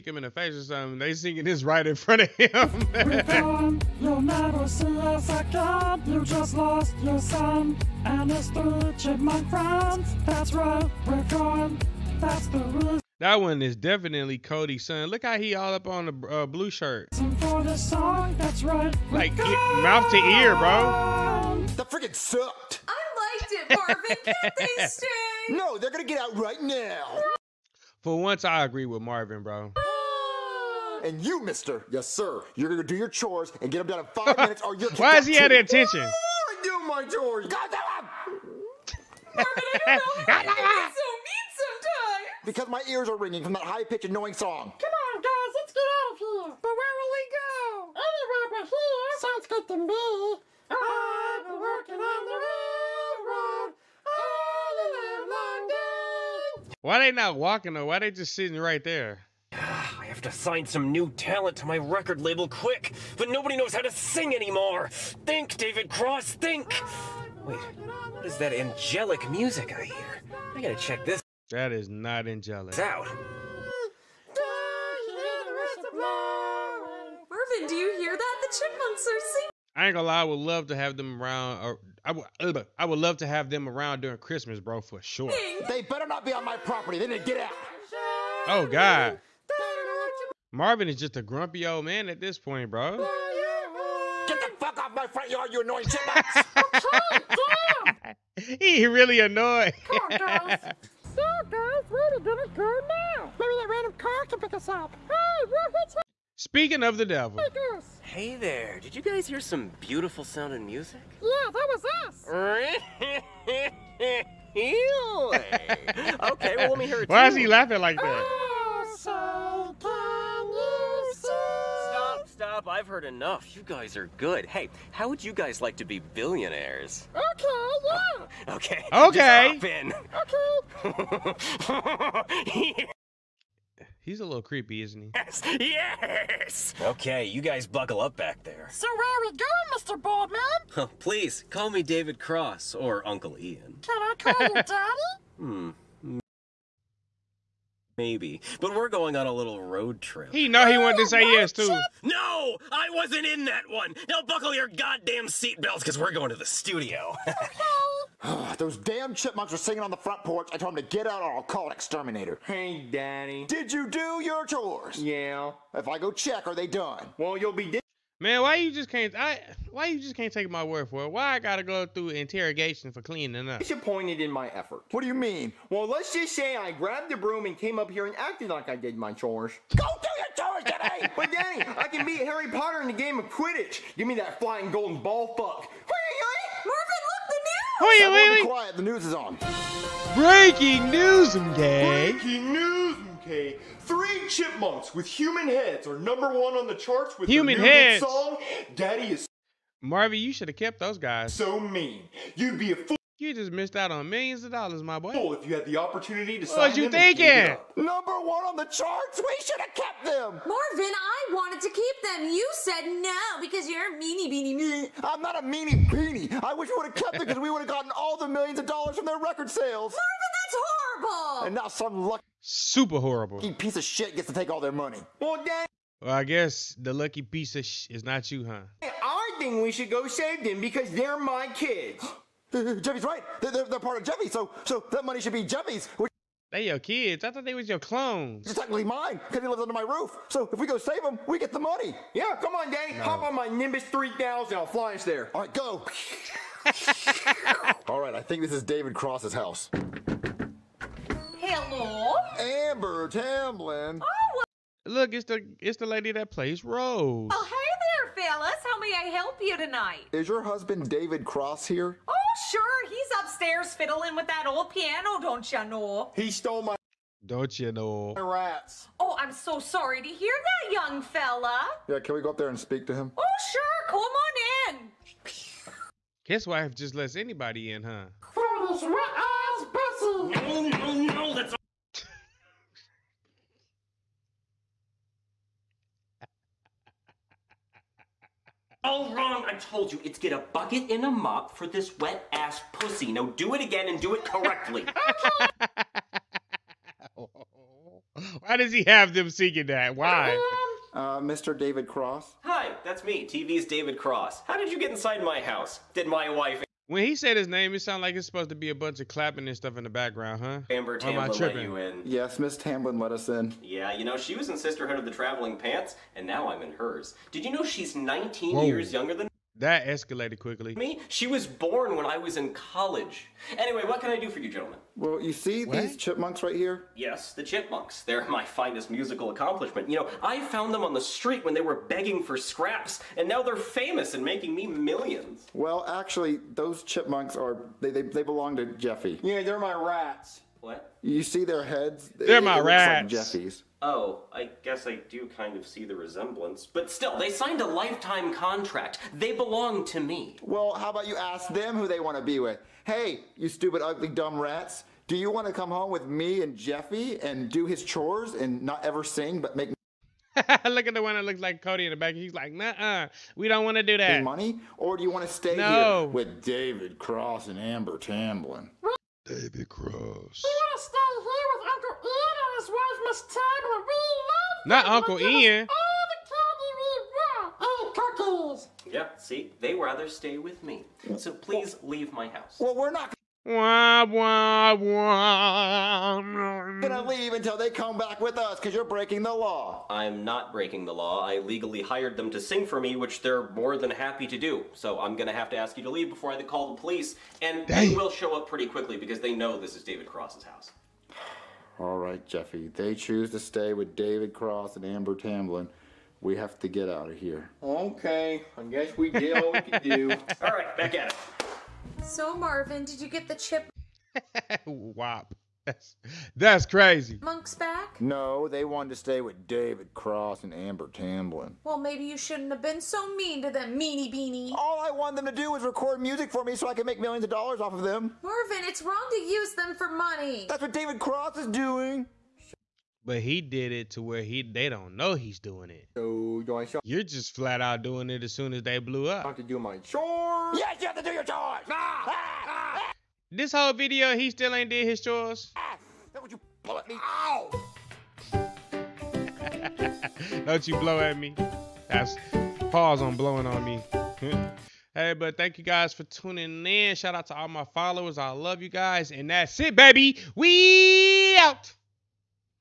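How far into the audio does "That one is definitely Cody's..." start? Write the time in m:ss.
0:13.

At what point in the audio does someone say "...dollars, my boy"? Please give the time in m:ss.
3:24.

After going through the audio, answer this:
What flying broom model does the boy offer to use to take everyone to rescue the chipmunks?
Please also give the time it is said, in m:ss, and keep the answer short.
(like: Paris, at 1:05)
Nimbus 3000, at 4:03.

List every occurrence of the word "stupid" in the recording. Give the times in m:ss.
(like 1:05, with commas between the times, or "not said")
5:53.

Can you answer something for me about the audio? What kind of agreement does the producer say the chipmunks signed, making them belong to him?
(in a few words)
Lifetime contract.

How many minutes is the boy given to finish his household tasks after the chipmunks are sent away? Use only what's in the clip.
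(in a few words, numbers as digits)
5.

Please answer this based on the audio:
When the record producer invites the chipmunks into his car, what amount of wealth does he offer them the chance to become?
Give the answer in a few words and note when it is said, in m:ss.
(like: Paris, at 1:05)
Billionaires, at 2:06.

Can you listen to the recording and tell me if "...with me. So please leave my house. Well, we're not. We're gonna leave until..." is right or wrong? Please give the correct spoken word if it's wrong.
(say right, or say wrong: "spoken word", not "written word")
right.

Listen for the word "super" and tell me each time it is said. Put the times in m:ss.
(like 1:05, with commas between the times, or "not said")
3:42.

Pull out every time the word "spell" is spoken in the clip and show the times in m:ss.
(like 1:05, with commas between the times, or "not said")
not said.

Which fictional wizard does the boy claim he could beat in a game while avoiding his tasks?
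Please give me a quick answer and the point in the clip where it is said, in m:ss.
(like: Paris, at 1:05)
Harry Potter, at 3:02.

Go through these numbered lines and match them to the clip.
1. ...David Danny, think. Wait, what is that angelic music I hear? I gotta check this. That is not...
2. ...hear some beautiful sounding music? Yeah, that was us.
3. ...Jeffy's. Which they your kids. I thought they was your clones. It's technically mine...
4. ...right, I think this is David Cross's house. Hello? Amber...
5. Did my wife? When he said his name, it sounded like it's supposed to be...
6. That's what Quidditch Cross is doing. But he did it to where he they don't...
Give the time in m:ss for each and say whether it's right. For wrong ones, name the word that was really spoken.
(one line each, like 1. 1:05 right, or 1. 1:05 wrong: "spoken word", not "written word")
1. 1:05 wrong: "Cross", not "Danny"
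2. 1:49 right
3. 3:55 right
4. 4:07 right
5. 5:05 right
6. 7:10 wrong: "David", not "Quidditch".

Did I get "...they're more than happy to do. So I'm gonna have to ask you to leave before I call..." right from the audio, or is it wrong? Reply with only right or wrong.
right.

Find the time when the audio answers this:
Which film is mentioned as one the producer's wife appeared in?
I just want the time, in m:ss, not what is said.
5:14.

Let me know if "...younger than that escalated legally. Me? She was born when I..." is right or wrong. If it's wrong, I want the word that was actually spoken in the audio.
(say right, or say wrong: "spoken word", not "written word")
wrong: "quickly", not "legally".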